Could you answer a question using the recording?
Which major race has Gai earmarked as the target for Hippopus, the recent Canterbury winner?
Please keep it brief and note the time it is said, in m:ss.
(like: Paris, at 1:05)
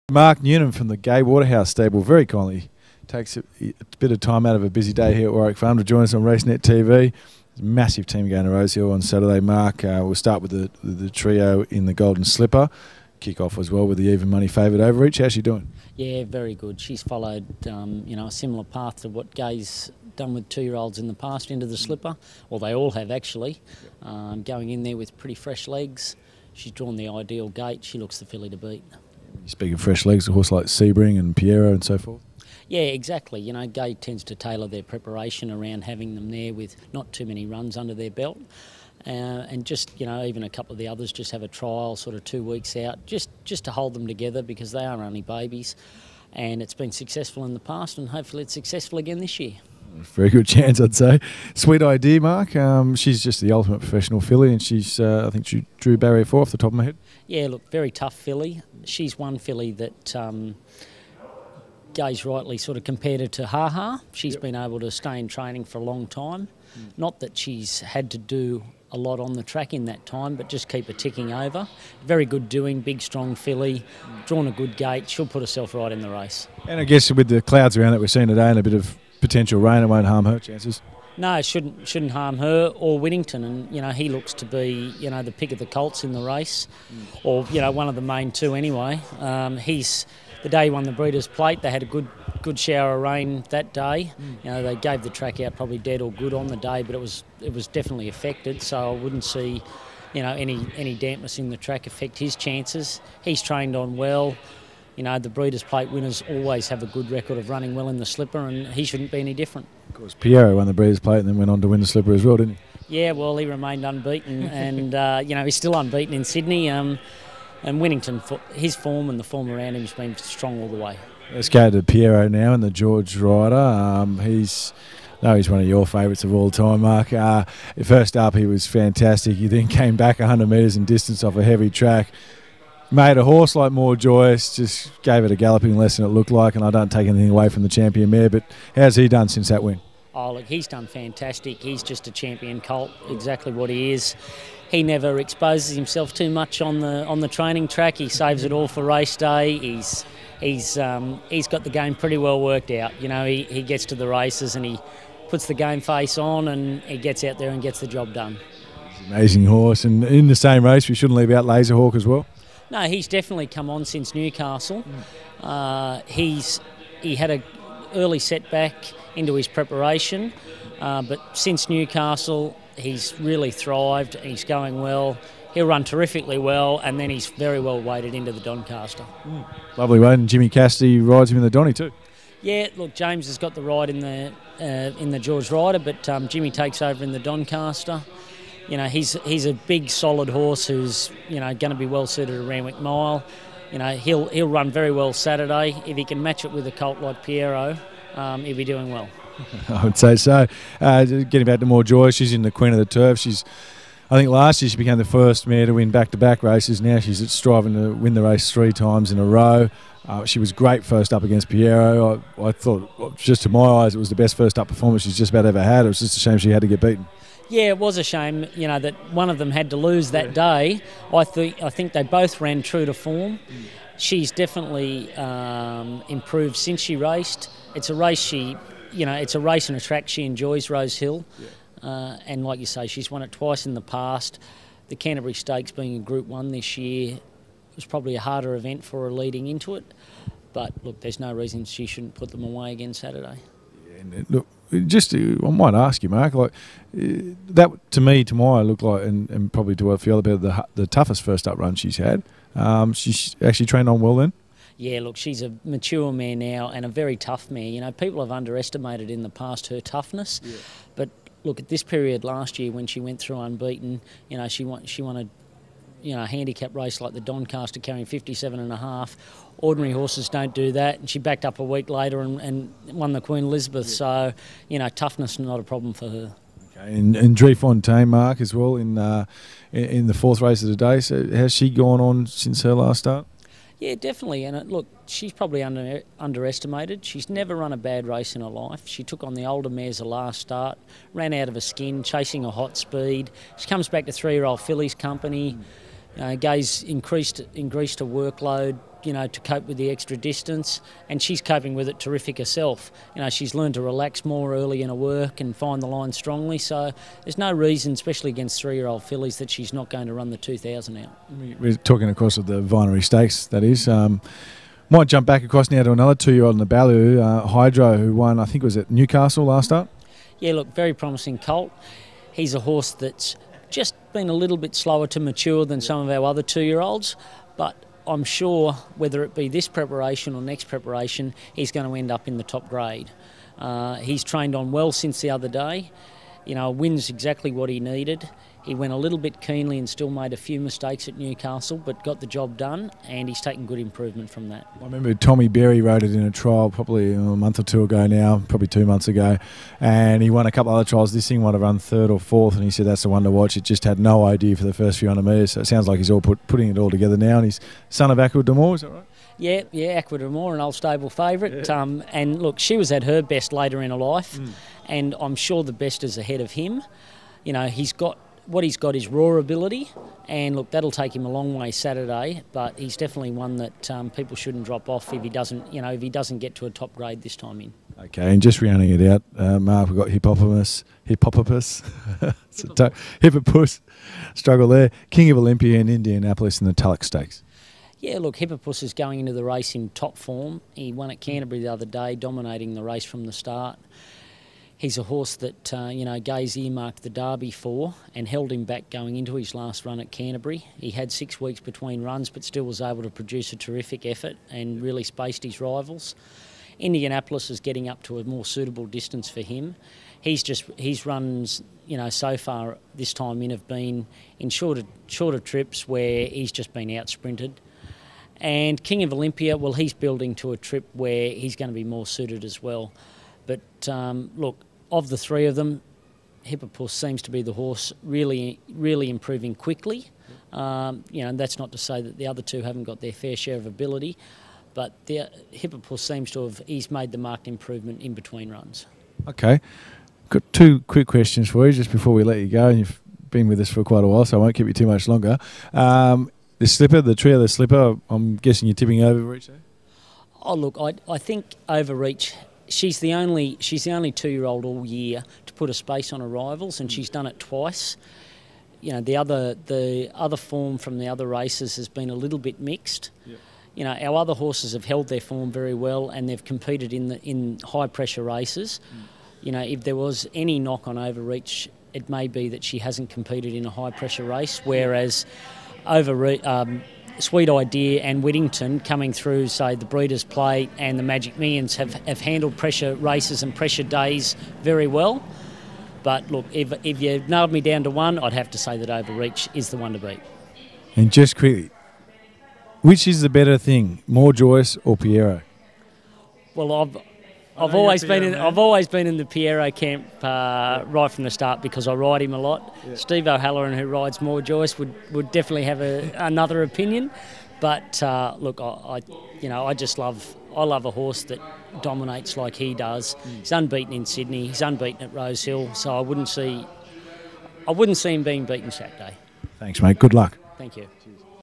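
The Derby, at 6:37.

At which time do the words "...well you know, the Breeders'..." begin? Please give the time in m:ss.
1:43.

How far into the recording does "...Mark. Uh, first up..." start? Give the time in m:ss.
2:06.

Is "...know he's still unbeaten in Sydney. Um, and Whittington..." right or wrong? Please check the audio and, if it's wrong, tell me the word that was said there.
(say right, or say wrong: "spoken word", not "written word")
right.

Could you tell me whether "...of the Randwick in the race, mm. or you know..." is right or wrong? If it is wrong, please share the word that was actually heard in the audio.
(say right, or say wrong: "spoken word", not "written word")
wrong: "Colts", not "Randwick".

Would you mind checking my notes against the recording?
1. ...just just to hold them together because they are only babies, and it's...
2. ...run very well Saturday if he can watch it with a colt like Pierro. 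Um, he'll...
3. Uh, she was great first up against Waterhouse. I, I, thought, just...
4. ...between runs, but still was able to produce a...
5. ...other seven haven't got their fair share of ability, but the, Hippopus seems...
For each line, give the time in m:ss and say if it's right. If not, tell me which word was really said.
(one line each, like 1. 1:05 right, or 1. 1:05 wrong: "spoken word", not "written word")
1. 0:43 right
2. 3:14 wrong: "match", not "watch"
3. 3:30 wrong: "Pierro", not "Waterhouse"
4. 6:41 right
5. 7:12 wrong: "two", not "seven".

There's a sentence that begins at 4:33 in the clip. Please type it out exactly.
So, you know, toughness not a problem for her.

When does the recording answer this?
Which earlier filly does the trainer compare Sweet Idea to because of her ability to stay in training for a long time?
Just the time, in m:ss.
1:03.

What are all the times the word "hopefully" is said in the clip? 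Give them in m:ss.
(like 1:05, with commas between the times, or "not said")
0:48.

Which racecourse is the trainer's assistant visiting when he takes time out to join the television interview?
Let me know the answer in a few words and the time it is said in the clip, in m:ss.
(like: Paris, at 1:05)
Warwick Farm, at 0:05.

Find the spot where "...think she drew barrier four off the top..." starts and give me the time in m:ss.
0:55.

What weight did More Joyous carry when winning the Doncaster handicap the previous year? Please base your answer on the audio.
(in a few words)
57.5.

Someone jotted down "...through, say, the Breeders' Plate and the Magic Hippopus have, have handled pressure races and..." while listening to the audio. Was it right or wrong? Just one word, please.
wrong.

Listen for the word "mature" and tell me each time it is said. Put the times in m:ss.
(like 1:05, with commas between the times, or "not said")
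4:15, 5:25.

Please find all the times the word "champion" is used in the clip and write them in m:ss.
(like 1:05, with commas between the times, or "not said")
2:17, 2:22.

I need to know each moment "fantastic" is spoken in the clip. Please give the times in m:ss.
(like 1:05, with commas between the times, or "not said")
2:08, 2:20.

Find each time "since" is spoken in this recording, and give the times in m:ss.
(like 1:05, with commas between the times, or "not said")
2:19, 2:43, 2:51, 3:46, 4:42, 5:34.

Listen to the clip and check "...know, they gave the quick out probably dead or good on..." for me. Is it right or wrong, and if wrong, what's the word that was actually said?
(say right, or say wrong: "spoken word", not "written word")
wrong: "track", not "quick".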